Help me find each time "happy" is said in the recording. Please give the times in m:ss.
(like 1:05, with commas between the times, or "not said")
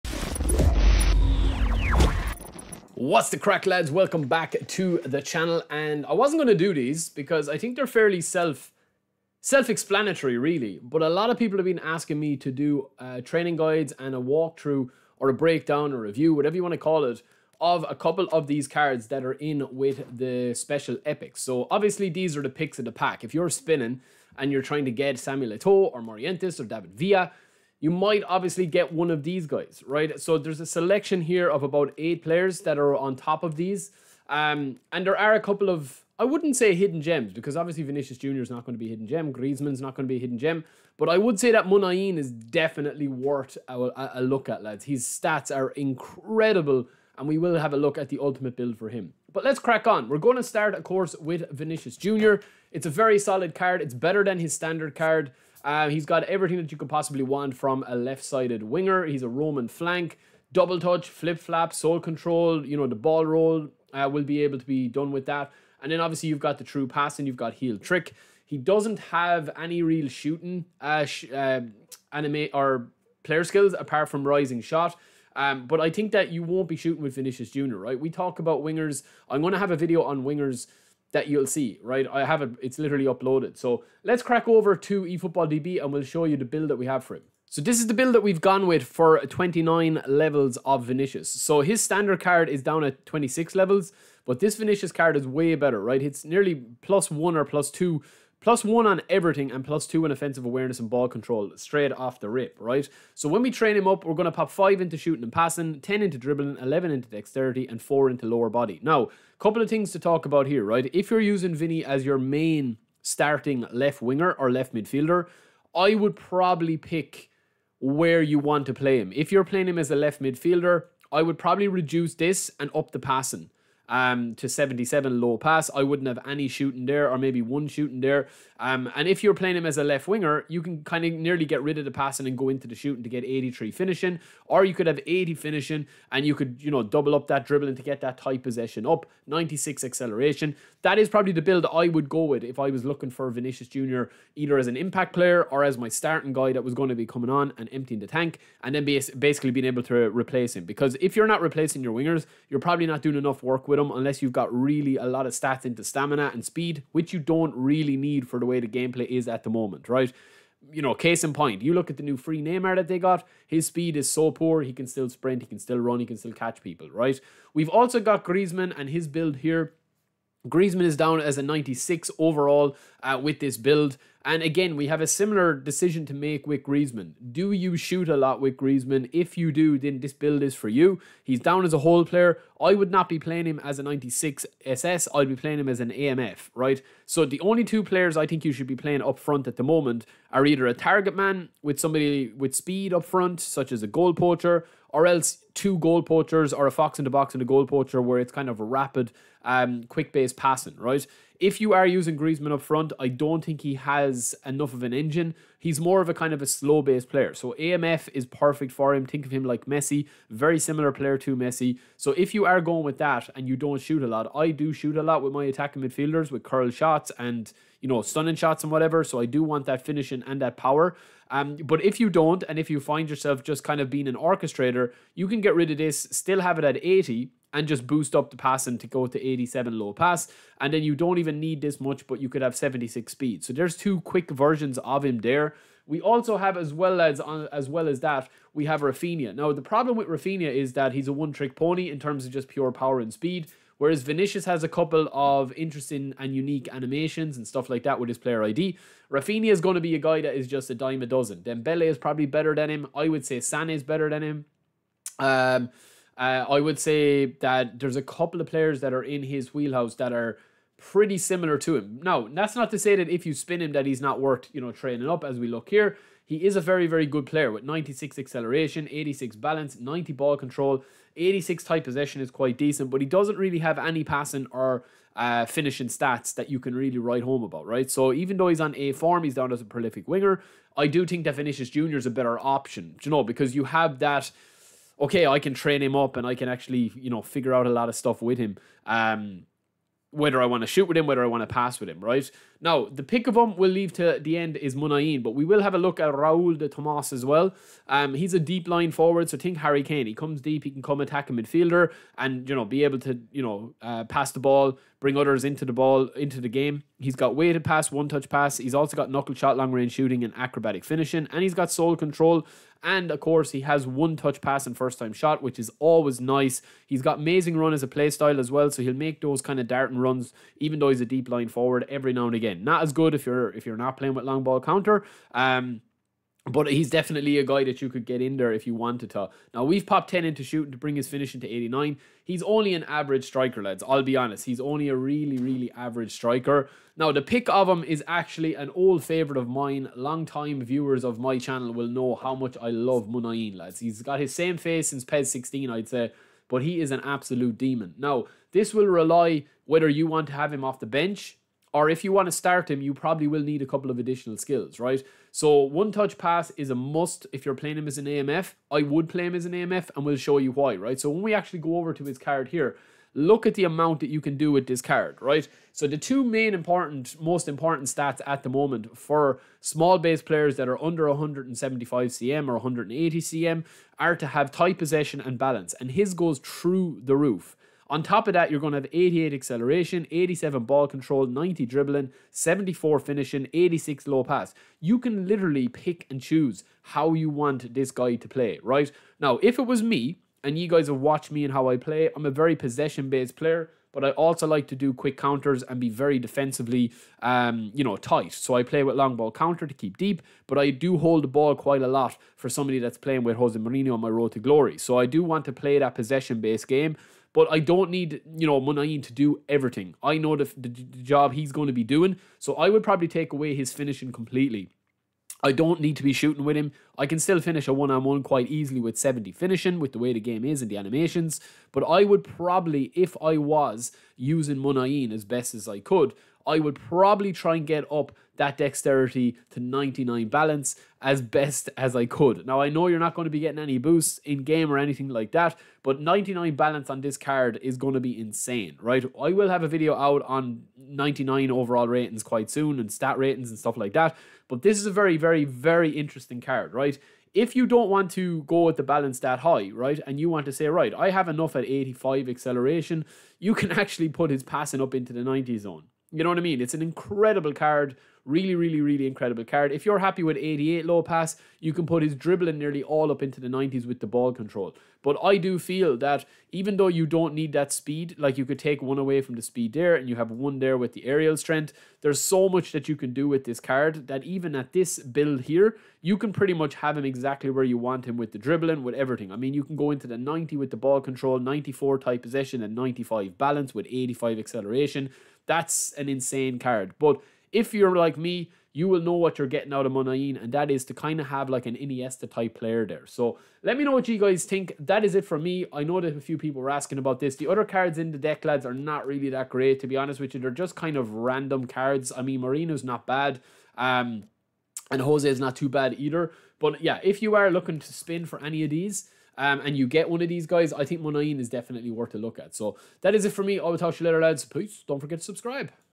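7:39.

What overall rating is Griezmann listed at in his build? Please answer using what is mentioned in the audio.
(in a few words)
96.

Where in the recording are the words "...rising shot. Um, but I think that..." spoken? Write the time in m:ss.
1:14.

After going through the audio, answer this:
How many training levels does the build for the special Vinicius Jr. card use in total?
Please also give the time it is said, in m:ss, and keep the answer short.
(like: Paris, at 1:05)
29, at 1:29.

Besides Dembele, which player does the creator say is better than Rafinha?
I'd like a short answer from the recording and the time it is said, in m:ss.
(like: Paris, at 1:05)
Sané, at 4:13.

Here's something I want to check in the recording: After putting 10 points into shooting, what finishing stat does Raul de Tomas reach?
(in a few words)
89.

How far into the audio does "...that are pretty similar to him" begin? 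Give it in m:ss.
4:19.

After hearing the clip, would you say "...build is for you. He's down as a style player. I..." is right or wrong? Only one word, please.
wrong.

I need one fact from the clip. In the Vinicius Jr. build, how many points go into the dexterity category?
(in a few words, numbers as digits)
11.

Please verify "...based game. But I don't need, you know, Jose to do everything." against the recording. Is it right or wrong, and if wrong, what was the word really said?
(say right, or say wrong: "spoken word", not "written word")
wrong: "Muniain", not "Jose".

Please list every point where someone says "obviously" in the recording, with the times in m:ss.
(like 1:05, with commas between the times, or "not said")
0:21, 0:28, 0:37, 1:05.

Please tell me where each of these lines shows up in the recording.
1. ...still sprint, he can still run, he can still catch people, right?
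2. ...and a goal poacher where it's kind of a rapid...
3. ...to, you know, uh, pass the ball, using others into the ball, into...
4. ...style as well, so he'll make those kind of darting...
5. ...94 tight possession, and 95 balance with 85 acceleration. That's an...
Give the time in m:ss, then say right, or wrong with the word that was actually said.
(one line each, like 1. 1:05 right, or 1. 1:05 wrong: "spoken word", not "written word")
1. 2:44 right
2. 3:17 right
3. 5:02 wrong: "bring", not "using"
4. 5:18 right
5. 8:01 right.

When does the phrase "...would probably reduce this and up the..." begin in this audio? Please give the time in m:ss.
2:01.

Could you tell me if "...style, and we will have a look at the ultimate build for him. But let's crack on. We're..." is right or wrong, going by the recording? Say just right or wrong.
wrong.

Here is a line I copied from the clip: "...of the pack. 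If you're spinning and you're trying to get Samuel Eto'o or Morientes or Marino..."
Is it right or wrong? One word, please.
wrong.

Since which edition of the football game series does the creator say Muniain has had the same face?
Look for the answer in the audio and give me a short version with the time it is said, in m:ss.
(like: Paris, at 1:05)
PES 16, at 5:45.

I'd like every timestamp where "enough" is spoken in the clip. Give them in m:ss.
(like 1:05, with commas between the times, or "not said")
2:33, 3:24, 7:31.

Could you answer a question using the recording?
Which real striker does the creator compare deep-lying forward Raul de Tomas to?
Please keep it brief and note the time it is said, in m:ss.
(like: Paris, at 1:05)
Harry Kane, at 4:59.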